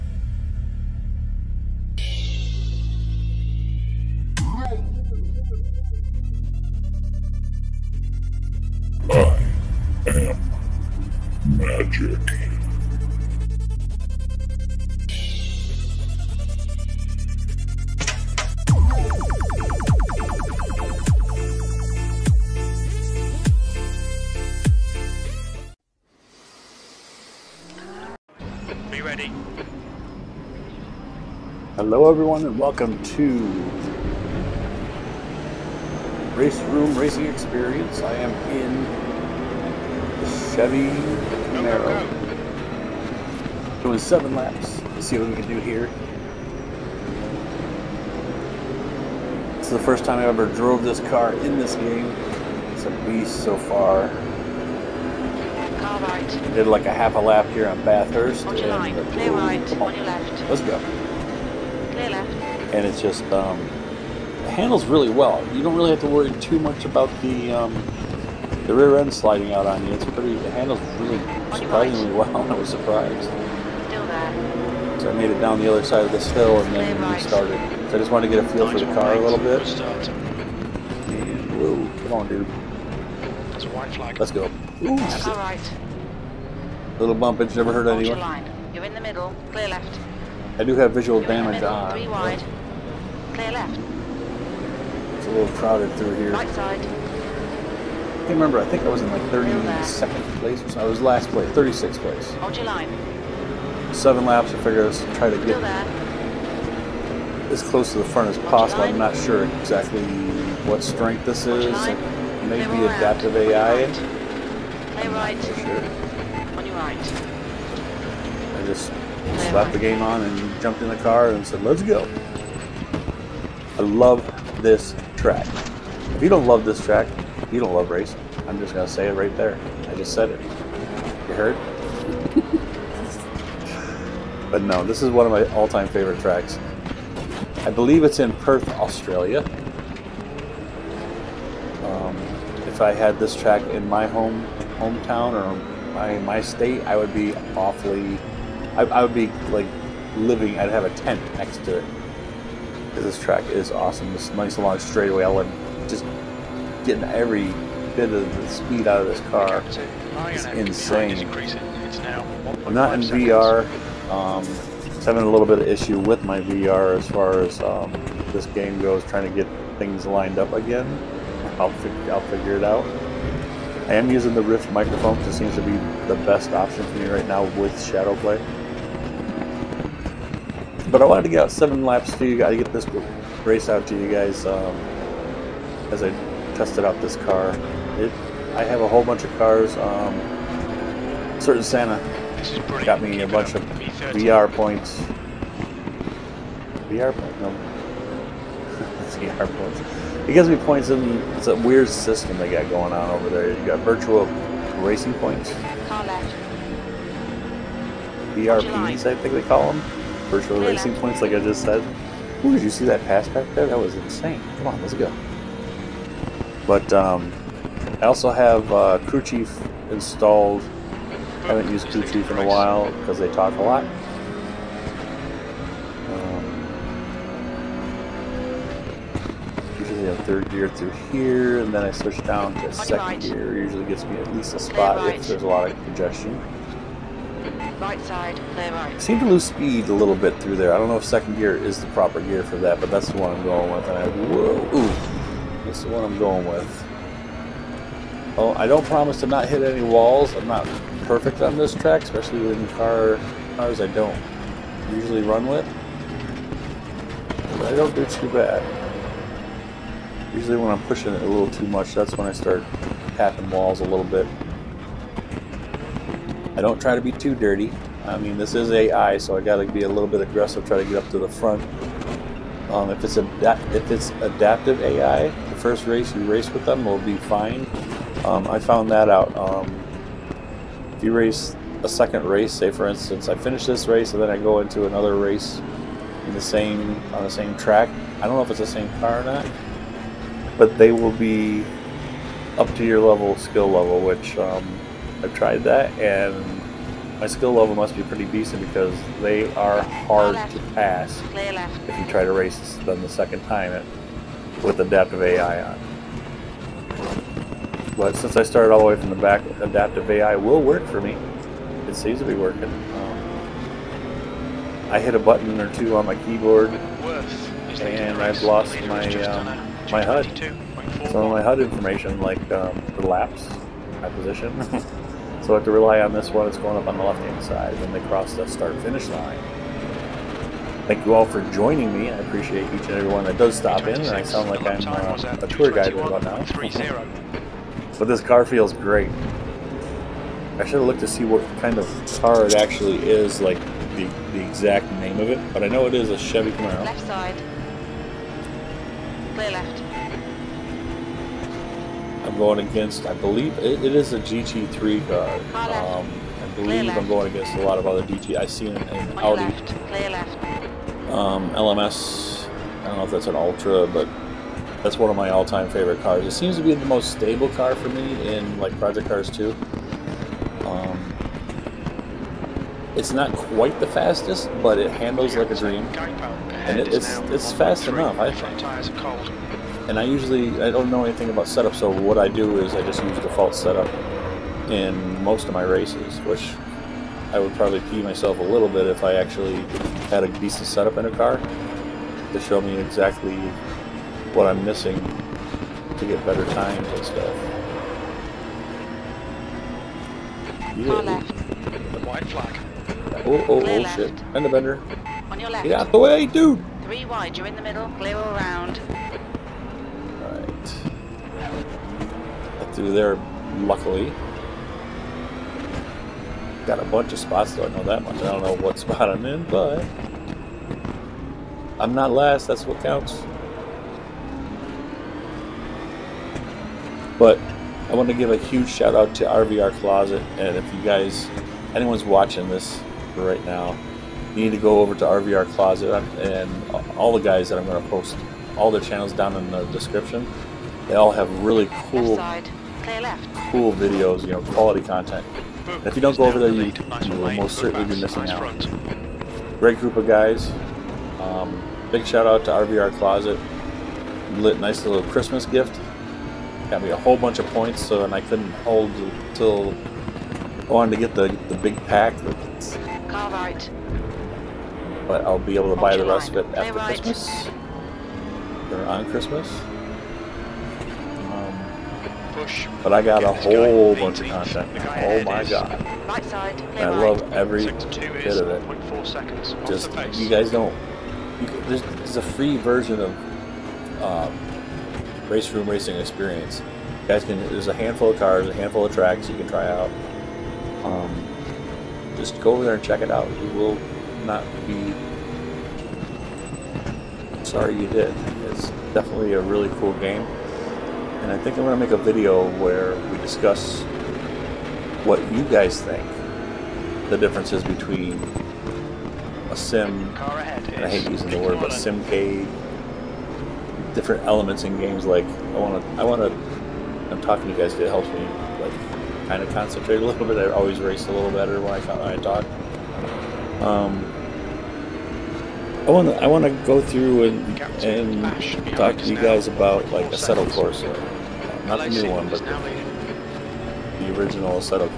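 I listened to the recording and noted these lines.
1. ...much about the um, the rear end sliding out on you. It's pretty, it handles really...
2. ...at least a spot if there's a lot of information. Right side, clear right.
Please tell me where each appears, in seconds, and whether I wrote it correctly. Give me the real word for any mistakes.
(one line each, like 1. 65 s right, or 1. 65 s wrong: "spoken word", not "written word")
1. 66 s right
2. 234 s wrong: "congestion", not "information".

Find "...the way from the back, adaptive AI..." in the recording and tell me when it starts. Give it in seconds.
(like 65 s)
308 s.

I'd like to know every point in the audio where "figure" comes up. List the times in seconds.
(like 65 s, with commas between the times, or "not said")
104 s, 172 s.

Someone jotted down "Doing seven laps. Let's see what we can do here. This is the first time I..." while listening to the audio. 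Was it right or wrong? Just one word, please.
right.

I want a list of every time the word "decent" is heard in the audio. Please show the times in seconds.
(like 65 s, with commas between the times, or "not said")
298 s, 390 s.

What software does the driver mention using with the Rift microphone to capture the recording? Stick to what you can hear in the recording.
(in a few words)
Shadow Play.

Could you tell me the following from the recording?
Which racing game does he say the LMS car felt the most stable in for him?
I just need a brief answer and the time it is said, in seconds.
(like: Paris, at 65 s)
Project Cars 2, at 368 s.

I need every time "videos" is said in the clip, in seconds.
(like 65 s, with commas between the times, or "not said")
443 s, 501 s.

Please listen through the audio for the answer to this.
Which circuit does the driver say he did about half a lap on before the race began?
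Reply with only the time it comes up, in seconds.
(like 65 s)
57 s.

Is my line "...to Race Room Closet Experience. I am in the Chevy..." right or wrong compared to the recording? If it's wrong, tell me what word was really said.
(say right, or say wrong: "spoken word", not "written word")
wrong: "Racing", not "Closet".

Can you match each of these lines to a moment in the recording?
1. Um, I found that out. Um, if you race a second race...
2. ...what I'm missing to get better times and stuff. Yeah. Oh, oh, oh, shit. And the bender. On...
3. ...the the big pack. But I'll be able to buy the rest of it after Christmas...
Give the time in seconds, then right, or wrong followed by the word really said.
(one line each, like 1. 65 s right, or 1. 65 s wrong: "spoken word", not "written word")
1. 278 s right
2. 394 s right
3. 461 s right.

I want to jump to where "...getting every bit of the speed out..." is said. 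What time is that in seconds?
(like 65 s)
156 s.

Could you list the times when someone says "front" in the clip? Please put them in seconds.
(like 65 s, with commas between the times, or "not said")
108 s, 271 s.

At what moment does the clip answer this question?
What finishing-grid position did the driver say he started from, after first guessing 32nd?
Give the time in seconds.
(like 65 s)
101 s.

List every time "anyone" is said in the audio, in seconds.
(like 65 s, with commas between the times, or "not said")
87 s, 431 s.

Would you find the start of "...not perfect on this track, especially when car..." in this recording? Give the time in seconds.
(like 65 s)
250 s.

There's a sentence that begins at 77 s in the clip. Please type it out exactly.
So I just wanted to get a feel for the car a little bit.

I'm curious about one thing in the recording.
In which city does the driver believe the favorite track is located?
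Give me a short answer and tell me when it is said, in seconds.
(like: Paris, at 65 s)
Perth, at 138 s.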